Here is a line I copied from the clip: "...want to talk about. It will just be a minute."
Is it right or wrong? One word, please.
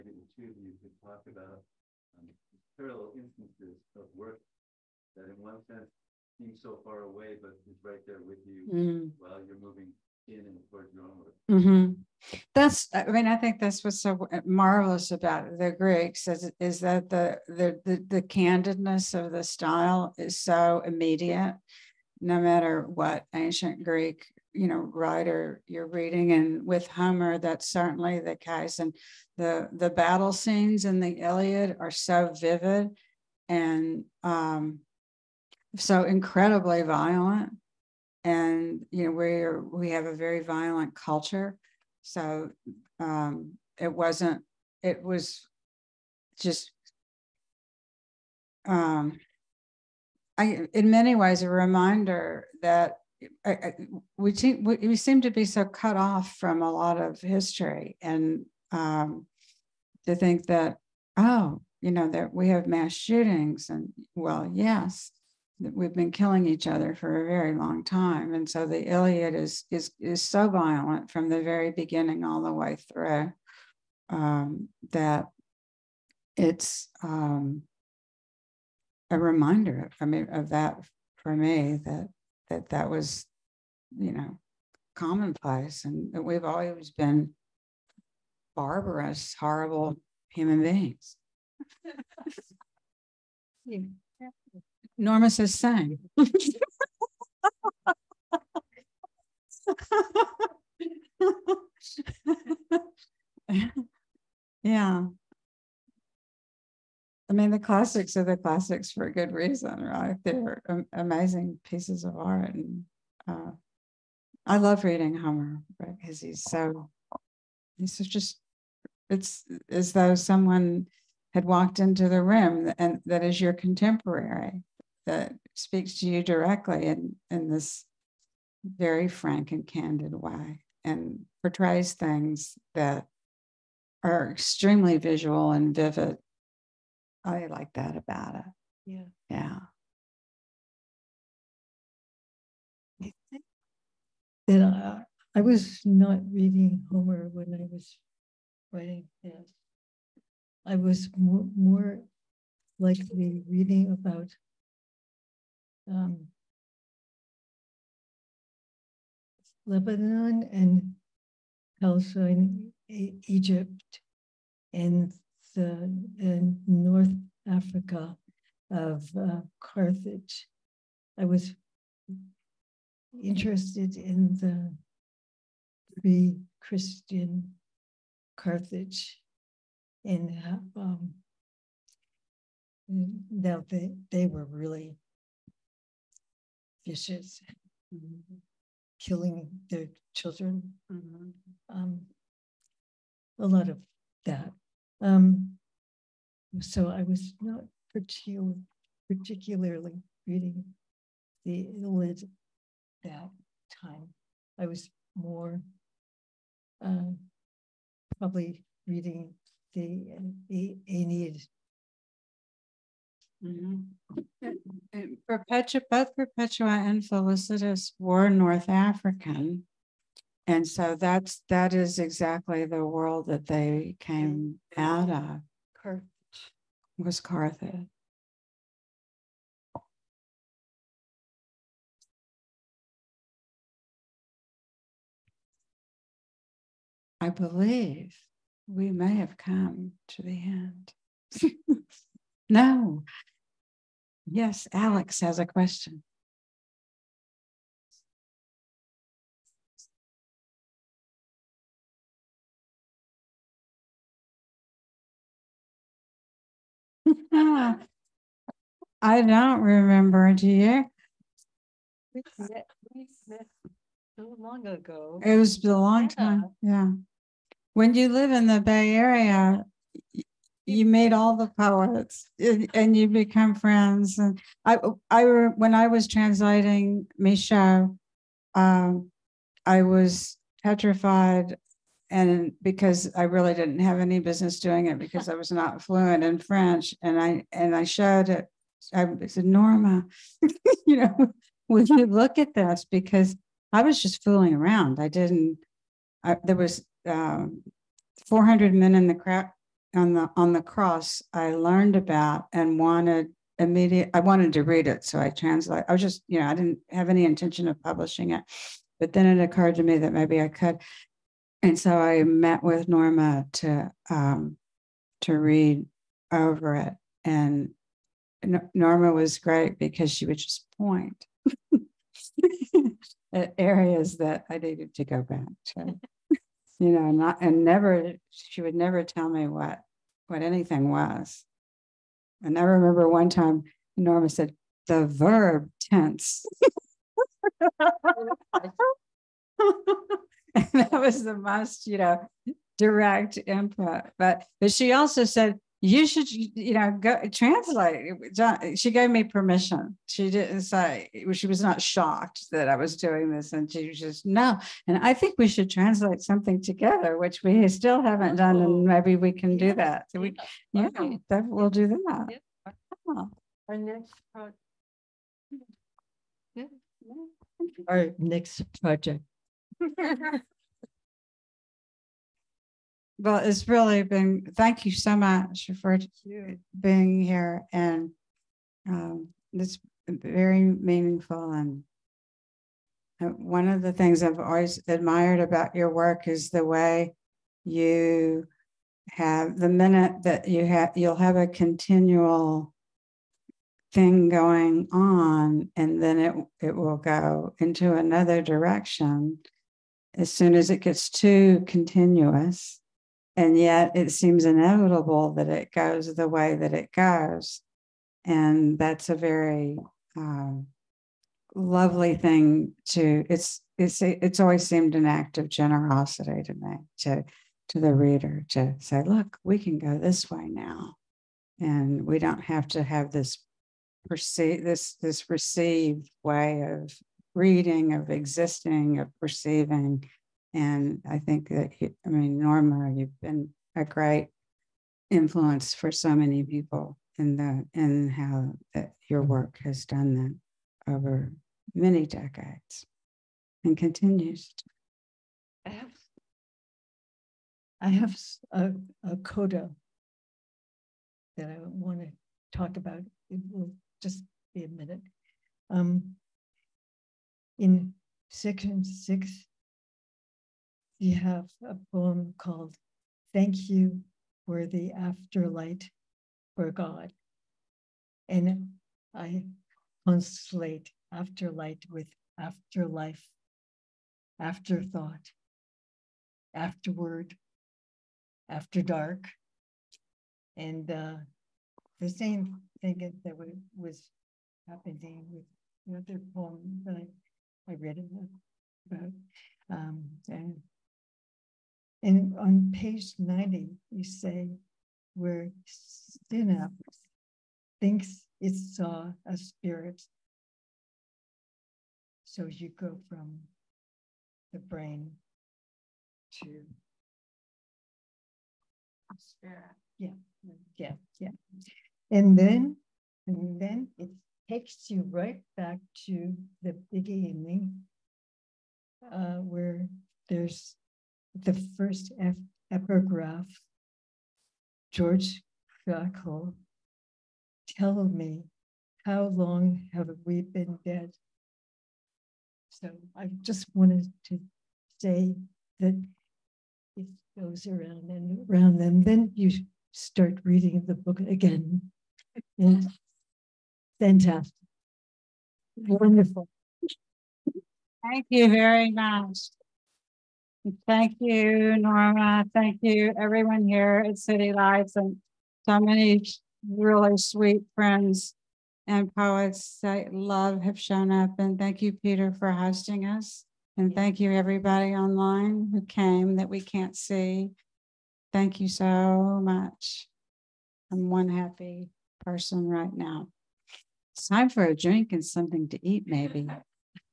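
right.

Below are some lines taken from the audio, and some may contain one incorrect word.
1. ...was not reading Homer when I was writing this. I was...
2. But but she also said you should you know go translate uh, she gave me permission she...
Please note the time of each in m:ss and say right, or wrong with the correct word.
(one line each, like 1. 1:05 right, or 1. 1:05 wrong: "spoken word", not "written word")
1. 2:25 right
2. 5:44 right.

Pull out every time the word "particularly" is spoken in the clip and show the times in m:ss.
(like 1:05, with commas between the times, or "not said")
3:17.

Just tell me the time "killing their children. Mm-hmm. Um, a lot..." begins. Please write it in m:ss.
3:08.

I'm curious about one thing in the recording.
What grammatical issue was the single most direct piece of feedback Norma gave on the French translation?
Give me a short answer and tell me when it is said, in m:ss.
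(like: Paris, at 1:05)
The verb tense, at 5:34.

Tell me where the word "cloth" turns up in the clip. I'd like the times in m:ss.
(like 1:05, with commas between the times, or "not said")
not said.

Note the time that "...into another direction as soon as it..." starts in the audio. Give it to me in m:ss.
6:37.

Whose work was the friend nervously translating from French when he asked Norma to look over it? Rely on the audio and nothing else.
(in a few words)
Michaux.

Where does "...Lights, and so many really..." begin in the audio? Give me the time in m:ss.
9:14.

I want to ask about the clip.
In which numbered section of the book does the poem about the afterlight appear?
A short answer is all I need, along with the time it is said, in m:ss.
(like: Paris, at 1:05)
Section 6, at 7:38.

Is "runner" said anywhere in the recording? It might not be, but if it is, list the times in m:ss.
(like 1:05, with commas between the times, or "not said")
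not said.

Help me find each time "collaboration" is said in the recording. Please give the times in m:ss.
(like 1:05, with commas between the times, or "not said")
not said.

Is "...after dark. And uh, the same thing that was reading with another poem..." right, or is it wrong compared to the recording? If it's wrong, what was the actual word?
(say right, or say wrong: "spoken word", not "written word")
wrong: "happening", not "reading".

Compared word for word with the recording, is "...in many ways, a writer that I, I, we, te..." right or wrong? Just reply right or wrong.
wrong.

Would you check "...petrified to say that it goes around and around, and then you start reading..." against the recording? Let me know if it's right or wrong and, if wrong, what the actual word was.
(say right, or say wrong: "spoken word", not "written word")
wrong: "wanted", not "petrified".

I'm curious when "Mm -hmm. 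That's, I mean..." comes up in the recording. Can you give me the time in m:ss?
0:11.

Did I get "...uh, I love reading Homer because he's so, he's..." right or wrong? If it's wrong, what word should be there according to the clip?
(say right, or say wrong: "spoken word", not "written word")
right.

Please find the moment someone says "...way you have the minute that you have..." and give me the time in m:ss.
6:26.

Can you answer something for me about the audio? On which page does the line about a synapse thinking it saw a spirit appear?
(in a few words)
90.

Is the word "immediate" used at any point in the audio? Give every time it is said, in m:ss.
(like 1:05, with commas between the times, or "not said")
0:20, 5:03.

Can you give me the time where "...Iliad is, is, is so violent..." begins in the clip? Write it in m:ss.
1:08.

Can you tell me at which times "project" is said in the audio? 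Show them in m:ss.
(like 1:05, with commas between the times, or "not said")
6:04, 6:08.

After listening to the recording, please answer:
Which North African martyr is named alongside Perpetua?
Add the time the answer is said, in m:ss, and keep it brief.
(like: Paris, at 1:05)
Felicitas, at 3:37.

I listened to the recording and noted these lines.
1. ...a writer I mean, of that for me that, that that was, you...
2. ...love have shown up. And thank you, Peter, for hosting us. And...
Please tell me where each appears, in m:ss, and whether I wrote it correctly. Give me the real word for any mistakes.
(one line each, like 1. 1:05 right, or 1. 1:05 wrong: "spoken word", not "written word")
1. 1:19 wrong: "reminder", not "writer"
2. 9:20 right.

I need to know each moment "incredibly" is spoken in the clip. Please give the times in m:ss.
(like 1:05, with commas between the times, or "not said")
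0:36.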